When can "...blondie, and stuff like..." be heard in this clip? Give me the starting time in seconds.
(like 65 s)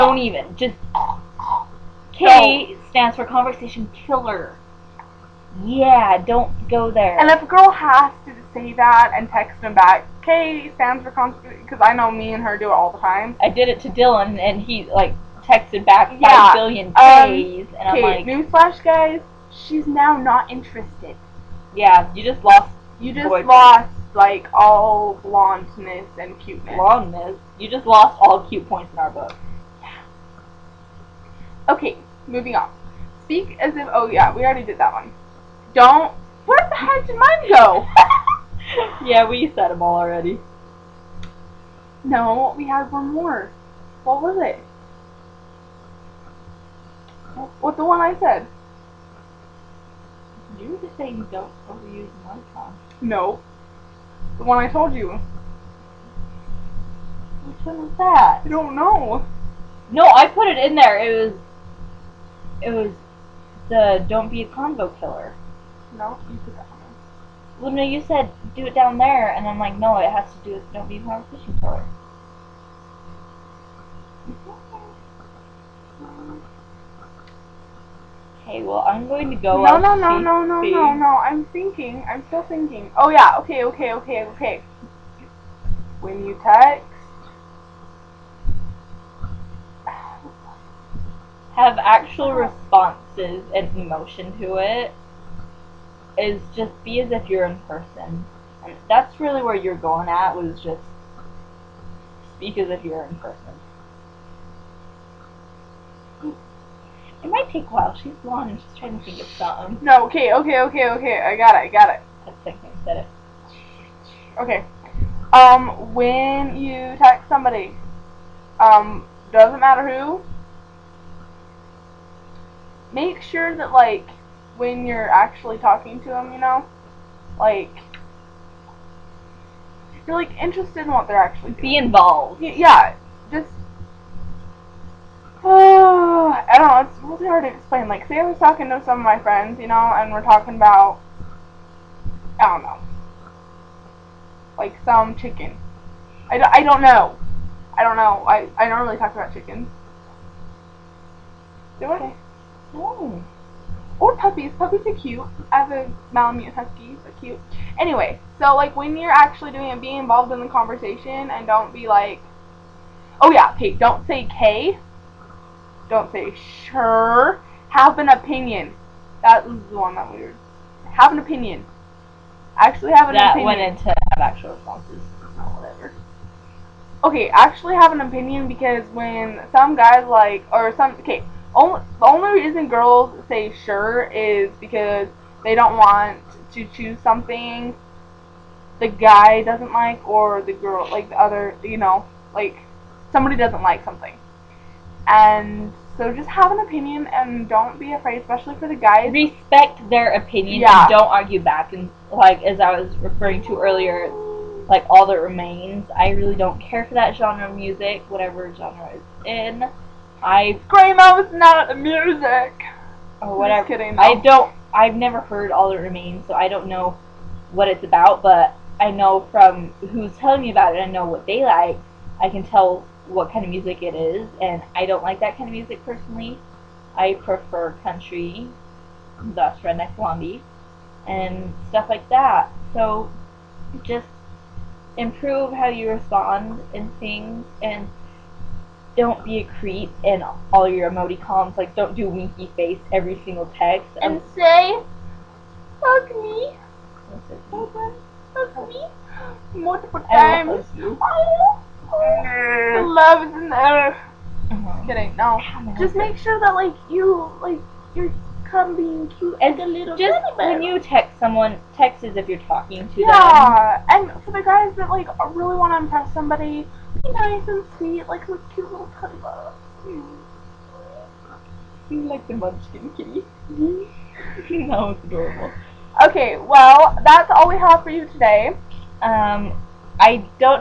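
229 s.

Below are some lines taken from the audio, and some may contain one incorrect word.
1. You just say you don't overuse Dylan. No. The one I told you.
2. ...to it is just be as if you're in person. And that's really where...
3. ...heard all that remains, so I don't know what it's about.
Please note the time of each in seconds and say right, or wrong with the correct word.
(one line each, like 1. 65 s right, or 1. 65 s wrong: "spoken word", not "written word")
1. 50 s wrong: "Minecraft", not "Dylan"
2. 94 s right
3. 215 s right.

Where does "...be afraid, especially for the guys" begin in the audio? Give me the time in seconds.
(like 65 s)
197 s.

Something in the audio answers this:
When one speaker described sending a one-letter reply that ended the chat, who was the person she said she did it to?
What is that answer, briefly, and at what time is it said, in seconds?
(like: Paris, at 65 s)
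Dylan, at 13 s.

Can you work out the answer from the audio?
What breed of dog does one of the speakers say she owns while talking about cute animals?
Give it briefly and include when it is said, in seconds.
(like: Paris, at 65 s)
Malamute Husky, at 156 s.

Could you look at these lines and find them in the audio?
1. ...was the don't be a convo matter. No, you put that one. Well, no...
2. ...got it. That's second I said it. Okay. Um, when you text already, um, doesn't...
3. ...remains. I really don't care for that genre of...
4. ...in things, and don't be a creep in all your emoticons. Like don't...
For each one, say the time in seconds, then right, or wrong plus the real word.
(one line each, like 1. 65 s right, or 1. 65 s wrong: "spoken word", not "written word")
1. 62 s wrong: "killer", not "matter"
2. 111 s wrong: "somebody", not "already"
3. 205 s right
4. 236 s right.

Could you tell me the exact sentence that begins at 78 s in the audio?
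Okay, well, I'm going to go No, no, no, no, no, no, no.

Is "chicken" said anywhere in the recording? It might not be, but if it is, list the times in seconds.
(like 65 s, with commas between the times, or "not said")
145 s, 149 s.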